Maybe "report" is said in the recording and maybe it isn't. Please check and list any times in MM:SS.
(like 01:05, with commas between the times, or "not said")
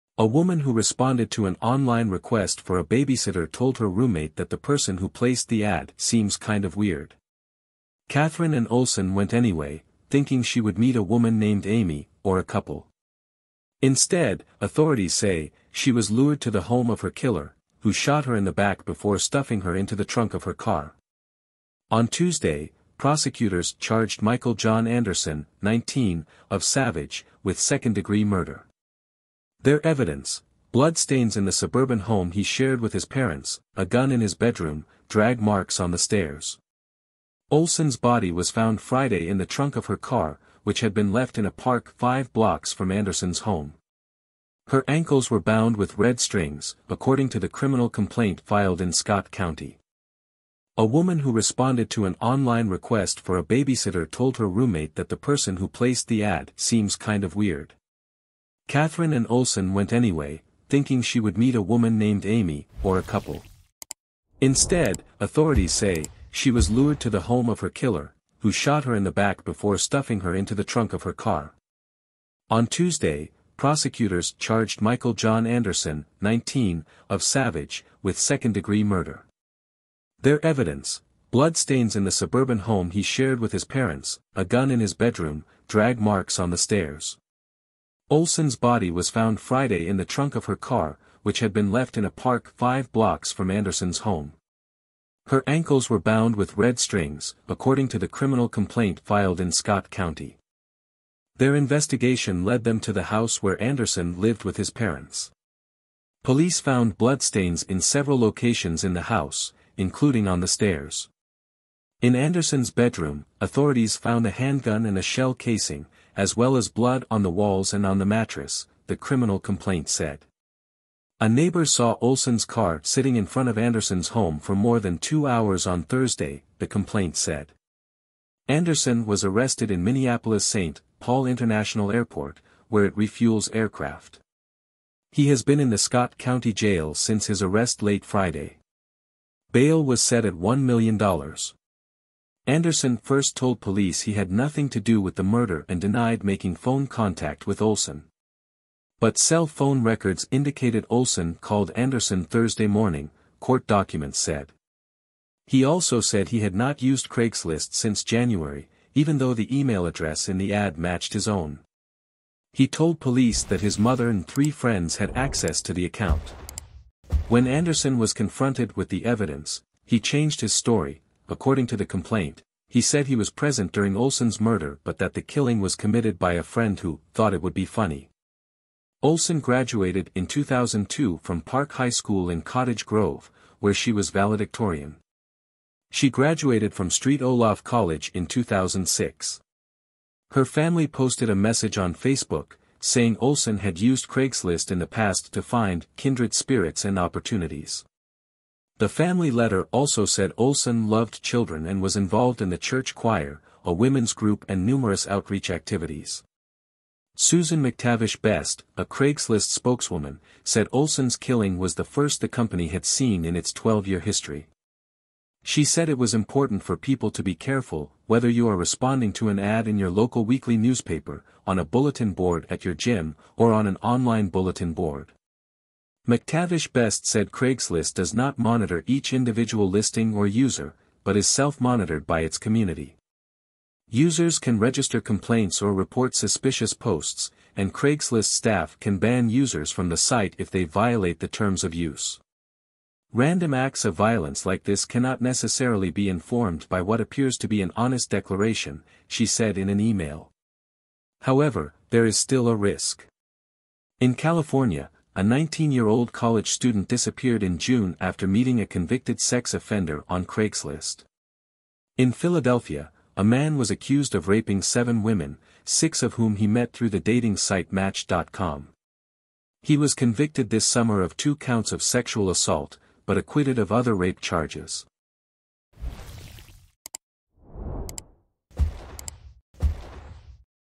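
03:55.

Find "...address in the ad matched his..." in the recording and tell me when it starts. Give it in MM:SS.
02:39.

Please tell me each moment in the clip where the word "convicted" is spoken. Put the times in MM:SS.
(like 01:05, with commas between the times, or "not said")
04:18, 04:29.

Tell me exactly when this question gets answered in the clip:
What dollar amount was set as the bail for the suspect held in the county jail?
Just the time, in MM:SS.
02:20.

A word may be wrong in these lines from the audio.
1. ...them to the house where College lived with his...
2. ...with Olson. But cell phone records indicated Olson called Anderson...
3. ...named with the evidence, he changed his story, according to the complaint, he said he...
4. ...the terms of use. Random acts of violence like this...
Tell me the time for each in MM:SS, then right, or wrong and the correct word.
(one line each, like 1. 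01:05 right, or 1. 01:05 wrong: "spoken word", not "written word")
1. 01:42 wrong: "Anderson", not "College"
2. 02:27 right
3. 02:48 wrong: "confronted", not "named"
4. 04:01 right.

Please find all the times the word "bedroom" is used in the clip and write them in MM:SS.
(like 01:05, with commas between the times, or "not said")
00:34, 01:24, 01:52.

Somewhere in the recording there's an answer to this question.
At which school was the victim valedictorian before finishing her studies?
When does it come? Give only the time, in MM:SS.
03:01.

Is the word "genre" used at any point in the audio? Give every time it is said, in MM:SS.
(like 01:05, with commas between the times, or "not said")
not said.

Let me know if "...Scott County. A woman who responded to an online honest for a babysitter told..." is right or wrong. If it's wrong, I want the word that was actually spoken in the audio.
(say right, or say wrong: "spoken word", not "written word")
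wrong: "request", not "honest".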